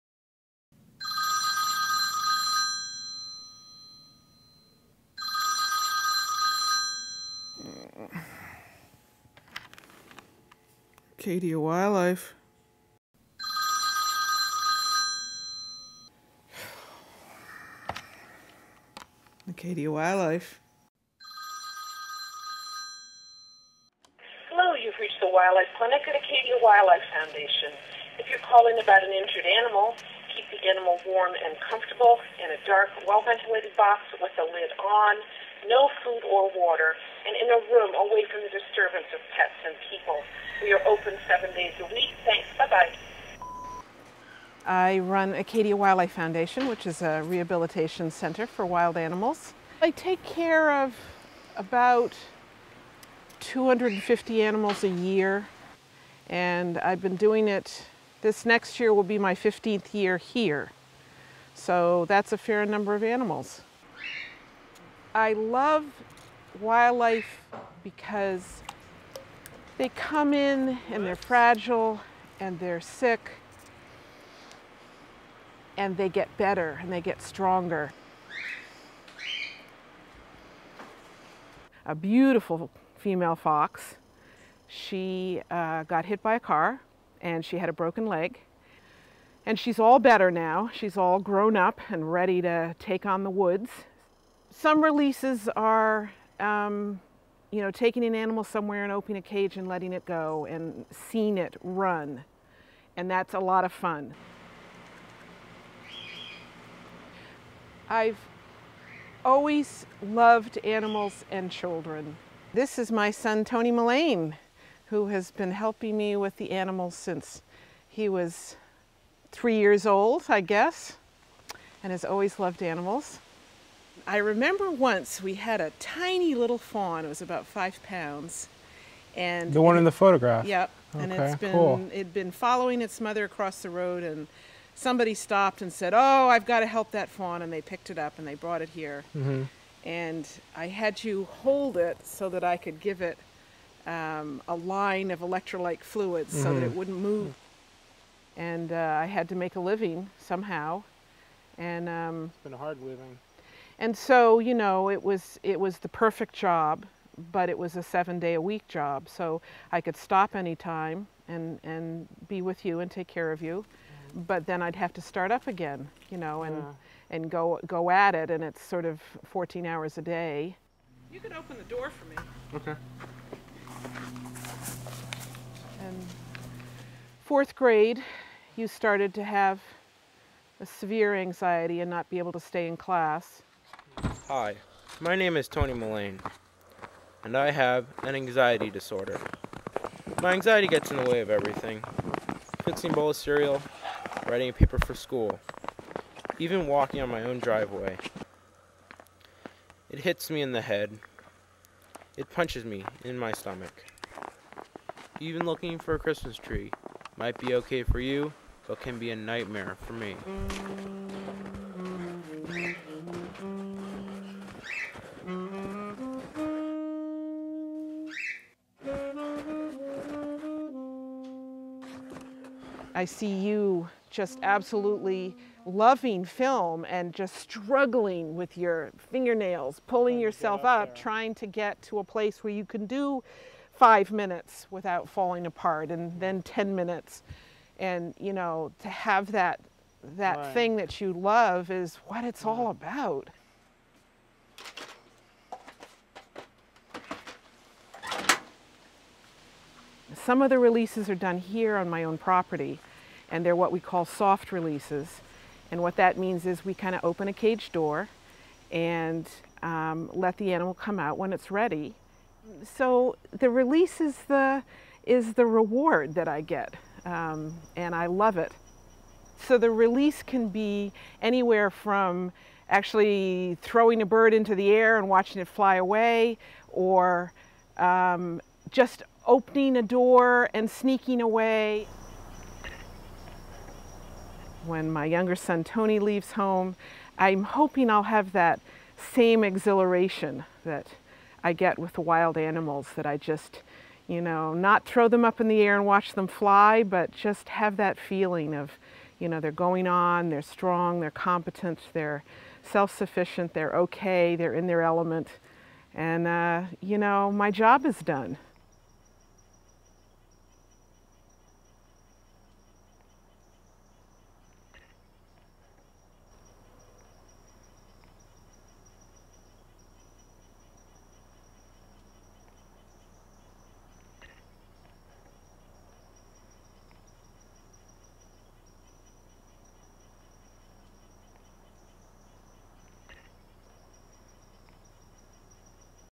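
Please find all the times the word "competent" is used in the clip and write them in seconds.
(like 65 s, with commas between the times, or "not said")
301 s.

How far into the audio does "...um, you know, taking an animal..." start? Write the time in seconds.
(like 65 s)
96 s.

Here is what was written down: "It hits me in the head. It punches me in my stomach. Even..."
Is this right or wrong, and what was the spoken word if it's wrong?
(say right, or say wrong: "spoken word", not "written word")
right.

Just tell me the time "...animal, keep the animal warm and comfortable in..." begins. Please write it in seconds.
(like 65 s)
29 s.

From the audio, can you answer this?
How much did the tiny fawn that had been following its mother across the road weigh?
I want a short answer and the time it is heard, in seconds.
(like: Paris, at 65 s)
5 pounds, at 127 s.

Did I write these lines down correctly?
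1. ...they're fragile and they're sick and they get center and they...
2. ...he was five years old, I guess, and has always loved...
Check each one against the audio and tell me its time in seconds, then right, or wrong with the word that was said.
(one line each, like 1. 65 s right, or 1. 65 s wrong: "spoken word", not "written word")
1. 71 s wrong: "better", not "center"
2. 117 s wrong: "three", not "five".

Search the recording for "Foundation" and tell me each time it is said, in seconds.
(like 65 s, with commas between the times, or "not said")
27 s, 46 s.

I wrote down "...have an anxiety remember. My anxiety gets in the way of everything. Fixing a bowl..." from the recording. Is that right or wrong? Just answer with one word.
wrong.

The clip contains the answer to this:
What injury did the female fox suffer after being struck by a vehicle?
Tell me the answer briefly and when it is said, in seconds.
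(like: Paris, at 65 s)
Broken leg, at 87 s.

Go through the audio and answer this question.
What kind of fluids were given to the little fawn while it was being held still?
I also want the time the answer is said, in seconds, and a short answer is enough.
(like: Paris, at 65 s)
Electrolyte fluids, at 145 s.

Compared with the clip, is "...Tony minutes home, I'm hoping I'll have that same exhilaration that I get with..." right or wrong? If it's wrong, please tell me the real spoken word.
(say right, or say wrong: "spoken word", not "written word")
wrong: "leaves", not "minutes".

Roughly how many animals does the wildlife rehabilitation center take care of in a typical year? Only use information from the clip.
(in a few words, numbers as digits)
250.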